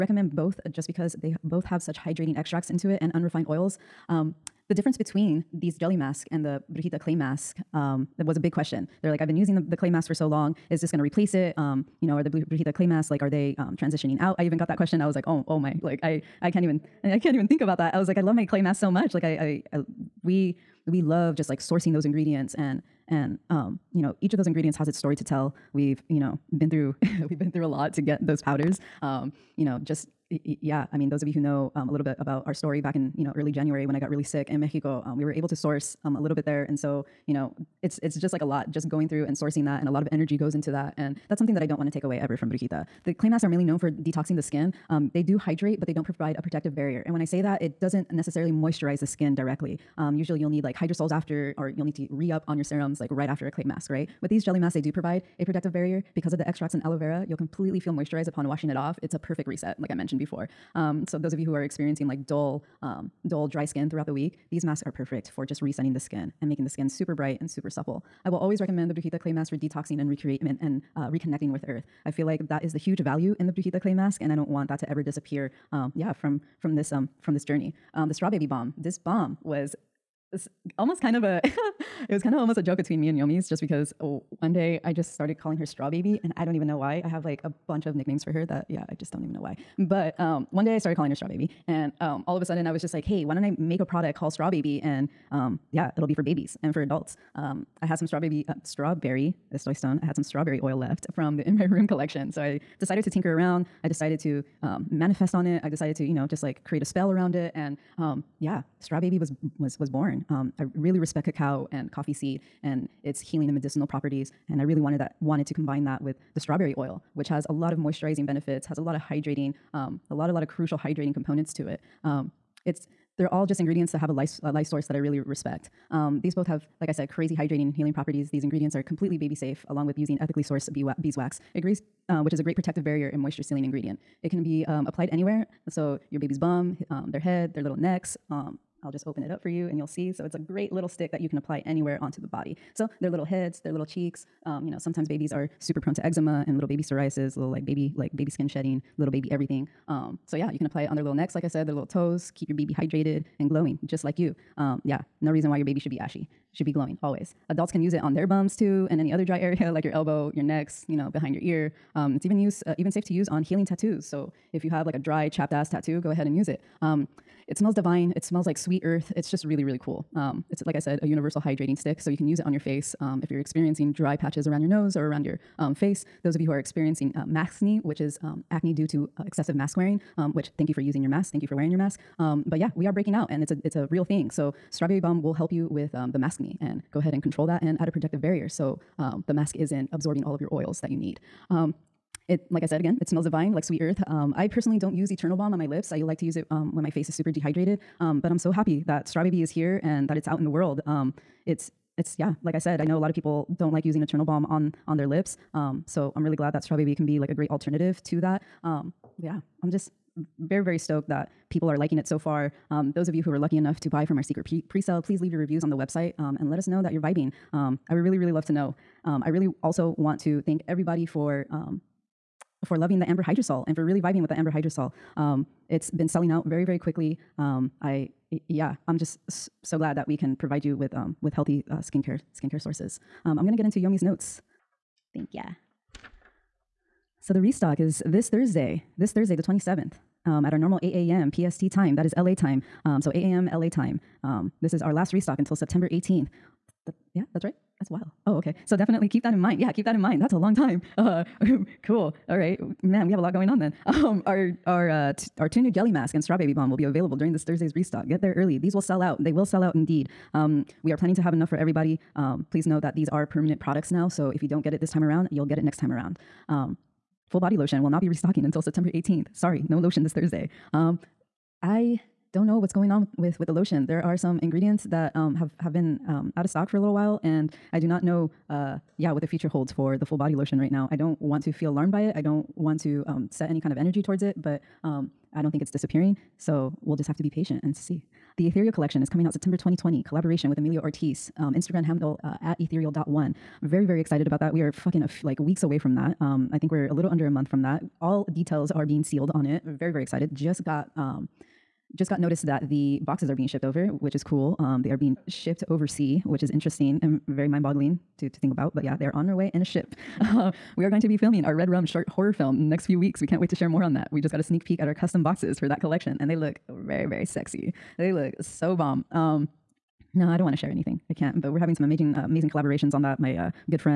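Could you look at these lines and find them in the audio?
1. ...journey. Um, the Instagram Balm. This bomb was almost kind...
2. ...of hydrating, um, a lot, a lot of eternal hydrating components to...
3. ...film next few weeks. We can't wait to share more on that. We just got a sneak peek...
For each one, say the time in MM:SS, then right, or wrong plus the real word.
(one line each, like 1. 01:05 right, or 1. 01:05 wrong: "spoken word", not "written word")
1. 01:17 wrong: "Strawbaby", not "Instagram"
2. 01:58 wrong: "crucial", not "eternal"
3. 05:12 right.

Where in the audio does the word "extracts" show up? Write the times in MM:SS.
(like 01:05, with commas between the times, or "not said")
00:02, 00:56.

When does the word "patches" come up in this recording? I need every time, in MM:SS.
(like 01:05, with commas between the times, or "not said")
02:54.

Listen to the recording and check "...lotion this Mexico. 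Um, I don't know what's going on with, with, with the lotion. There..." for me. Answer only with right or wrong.
wrong.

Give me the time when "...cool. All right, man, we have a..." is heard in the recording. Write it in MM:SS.
04:11.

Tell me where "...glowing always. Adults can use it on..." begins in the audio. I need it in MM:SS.
02:36.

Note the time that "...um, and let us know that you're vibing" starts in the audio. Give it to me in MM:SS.
03:36.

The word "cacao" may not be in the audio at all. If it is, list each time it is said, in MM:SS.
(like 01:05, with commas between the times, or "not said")
01:51.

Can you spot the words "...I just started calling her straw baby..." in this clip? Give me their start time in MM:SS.
01:24.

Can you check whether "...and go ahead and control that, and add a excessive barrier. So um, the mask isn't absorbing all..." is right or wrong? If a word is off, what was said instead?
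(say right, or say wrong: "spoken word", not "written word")
wrong: "protective", not "excessive".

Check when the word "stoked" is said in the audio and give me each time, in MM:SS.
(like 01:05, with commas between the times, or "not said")
03:30.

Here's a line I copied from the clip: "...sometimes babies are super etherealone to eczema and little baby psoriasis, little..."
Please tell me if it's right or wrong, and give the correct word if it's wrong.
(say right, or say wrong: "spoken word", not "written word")
wrong: "prone", not "etherealone".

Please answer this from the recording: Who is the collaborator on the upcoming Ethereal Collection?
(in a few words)
Emilio Ortiz.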